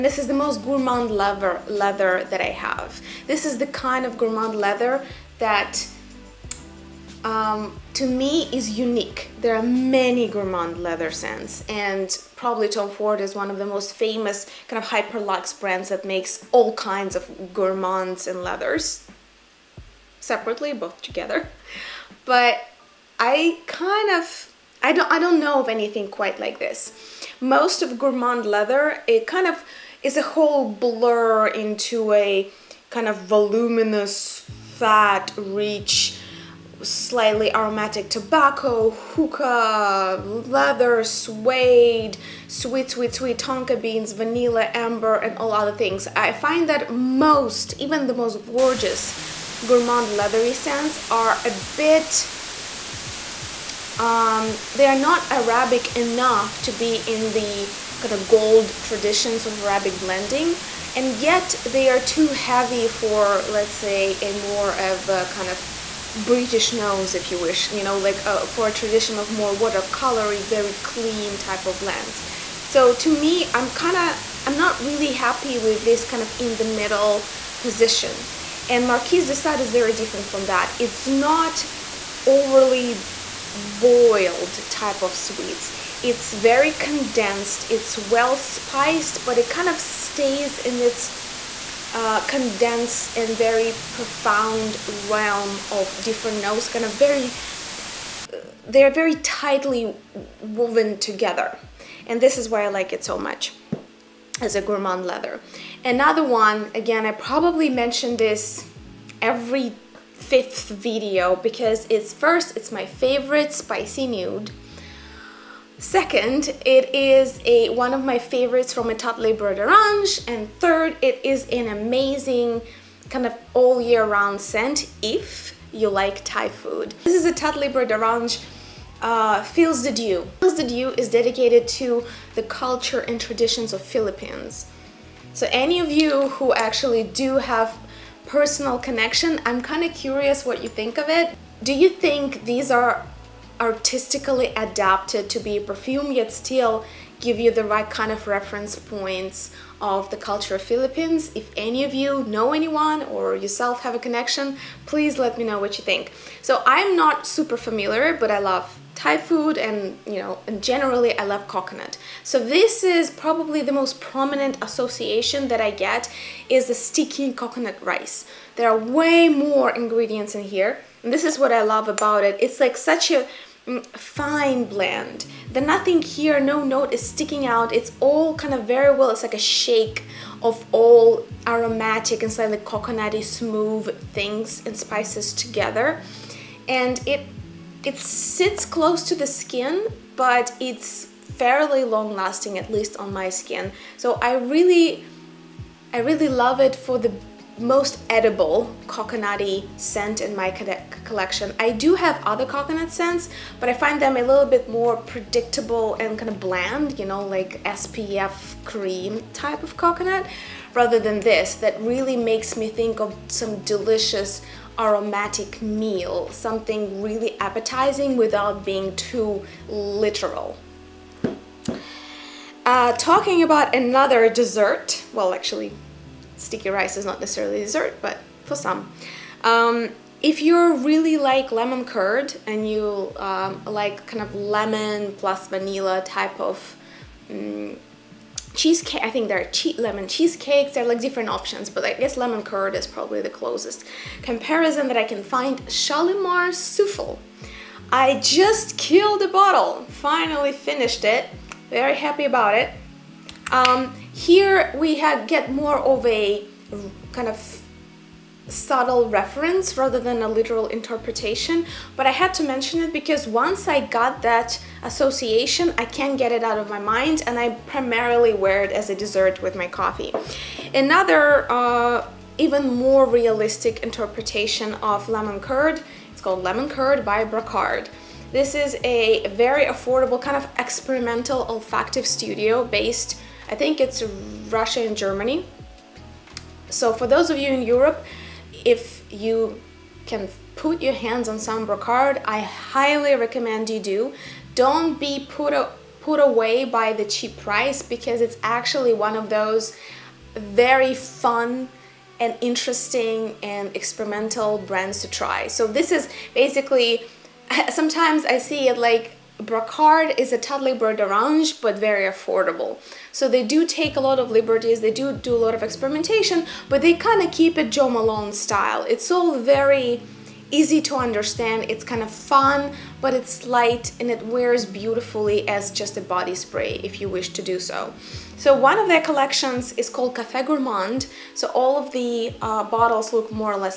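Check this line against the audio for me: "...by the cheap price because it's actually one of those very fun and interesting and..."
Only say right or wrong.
right.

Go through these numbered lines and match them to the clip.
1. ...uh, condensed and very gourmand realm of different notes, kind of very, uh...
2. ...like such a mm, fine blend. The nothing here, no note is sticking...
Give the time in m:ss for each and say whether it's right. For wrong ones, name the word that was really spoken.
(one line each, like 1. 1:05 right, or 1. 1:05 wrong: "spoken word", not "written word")
1. 1:31 wrong: "profound", not "gourmand"
2. 2:52 right.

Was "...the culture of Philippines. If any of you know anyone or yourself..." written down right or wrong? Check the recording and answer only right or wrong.
right.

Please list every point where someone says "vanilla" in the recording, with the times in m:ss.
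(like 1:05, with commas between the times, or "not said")
0:44, 3:55.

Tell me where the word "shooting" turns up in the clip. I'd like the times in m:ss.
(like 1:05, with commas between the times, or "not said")
not said.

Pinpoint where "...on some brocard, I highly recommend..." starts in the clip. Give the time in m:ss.
4:51.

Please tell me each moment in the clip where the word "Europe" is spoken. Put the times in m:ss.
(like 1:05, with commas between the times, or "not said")
4:47.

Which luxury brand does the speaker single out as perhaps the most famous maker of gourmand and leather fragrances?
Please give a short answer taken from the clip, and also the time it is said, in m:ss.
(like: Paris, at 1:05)
Tom Ford, at 0:12.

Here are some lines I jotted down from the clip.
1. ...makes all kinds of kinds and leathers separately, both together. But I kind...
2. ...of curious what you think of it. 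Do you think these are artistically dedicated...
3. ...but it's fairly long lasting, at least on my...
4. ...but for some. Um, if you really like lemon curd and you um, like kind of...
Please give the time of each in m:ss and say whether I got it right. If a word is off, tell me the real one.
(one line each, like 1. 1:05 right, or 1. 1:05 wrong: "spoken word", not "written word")
1. 0:16 wrong: "gourmands", not "kinds"
2. 2:19 wrong: "adapted", not "dedicated"
3. 3:10 right
4. 3:48 right.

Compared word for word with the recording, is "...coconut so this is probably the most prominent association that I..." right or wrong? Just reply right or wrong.
right.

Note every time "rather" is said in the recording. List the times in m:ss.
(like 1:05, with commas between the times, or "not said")
3:30, 4:19.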